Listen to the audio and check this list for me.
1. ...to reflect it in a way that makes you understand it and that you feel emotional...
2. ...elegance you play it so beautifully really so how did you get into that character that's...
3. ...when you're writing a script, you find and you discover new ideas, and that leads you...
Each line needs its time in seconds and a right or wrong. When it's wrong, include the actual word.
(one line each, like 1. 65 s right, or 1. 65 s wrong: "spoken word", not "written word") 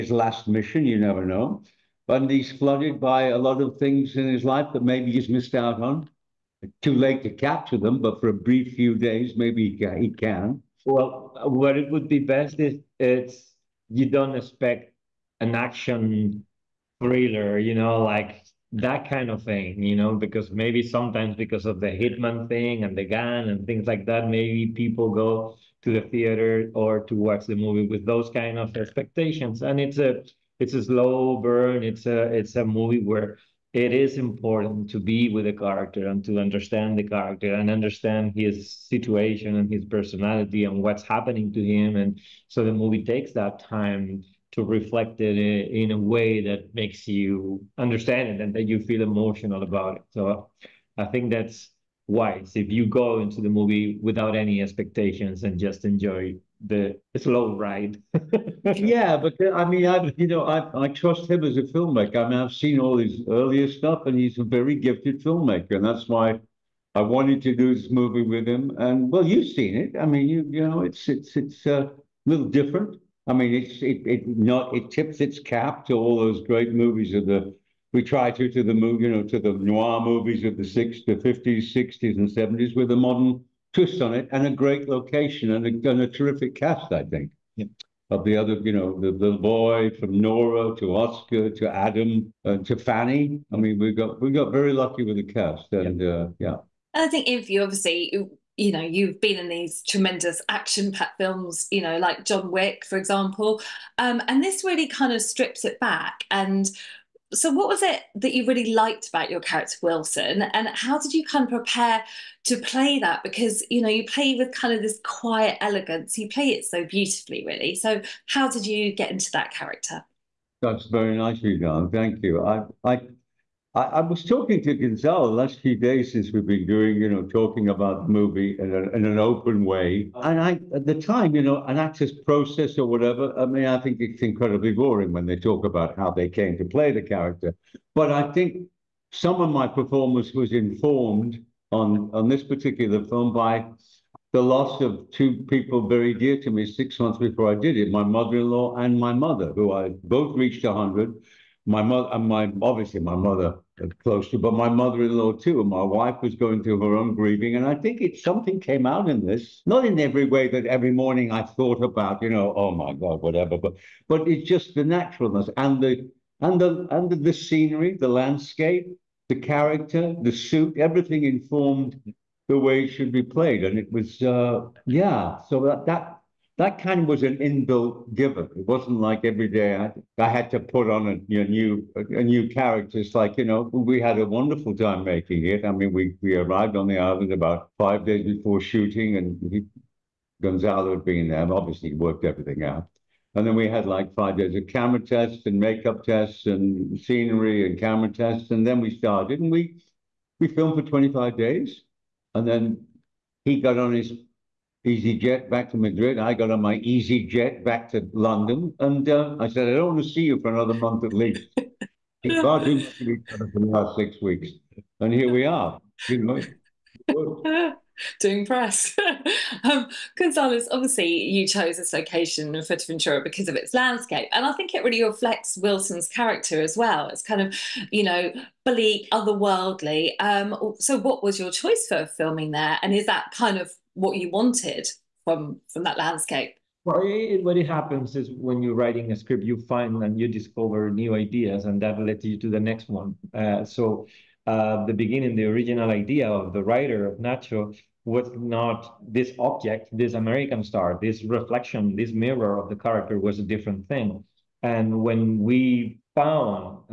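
1. 44 s right
2. 115 s right
3. 238 s right.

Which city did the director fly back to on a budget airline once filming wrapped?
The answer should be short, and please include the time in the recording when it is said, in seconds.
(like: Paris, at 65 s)
Madrid, at 205 s.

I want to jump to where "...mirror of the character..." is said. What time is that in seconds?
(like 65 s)
252 s.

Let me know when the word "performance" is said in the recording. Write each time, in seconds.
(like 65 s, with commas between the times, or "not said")
139 s.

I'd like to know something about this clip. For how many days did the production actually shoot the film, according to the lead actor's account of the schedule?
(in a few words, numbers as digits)
25.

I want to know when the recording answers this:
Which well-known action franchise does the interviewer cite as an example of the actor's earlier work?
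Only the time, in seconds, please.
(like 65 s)
102 s.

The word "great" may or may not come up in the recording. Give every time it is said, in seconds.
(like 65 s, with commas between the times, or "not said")
76 s, 84 s.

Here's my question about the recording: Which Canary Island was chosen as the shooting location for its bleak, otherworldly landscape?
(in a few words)
Fuerteventura.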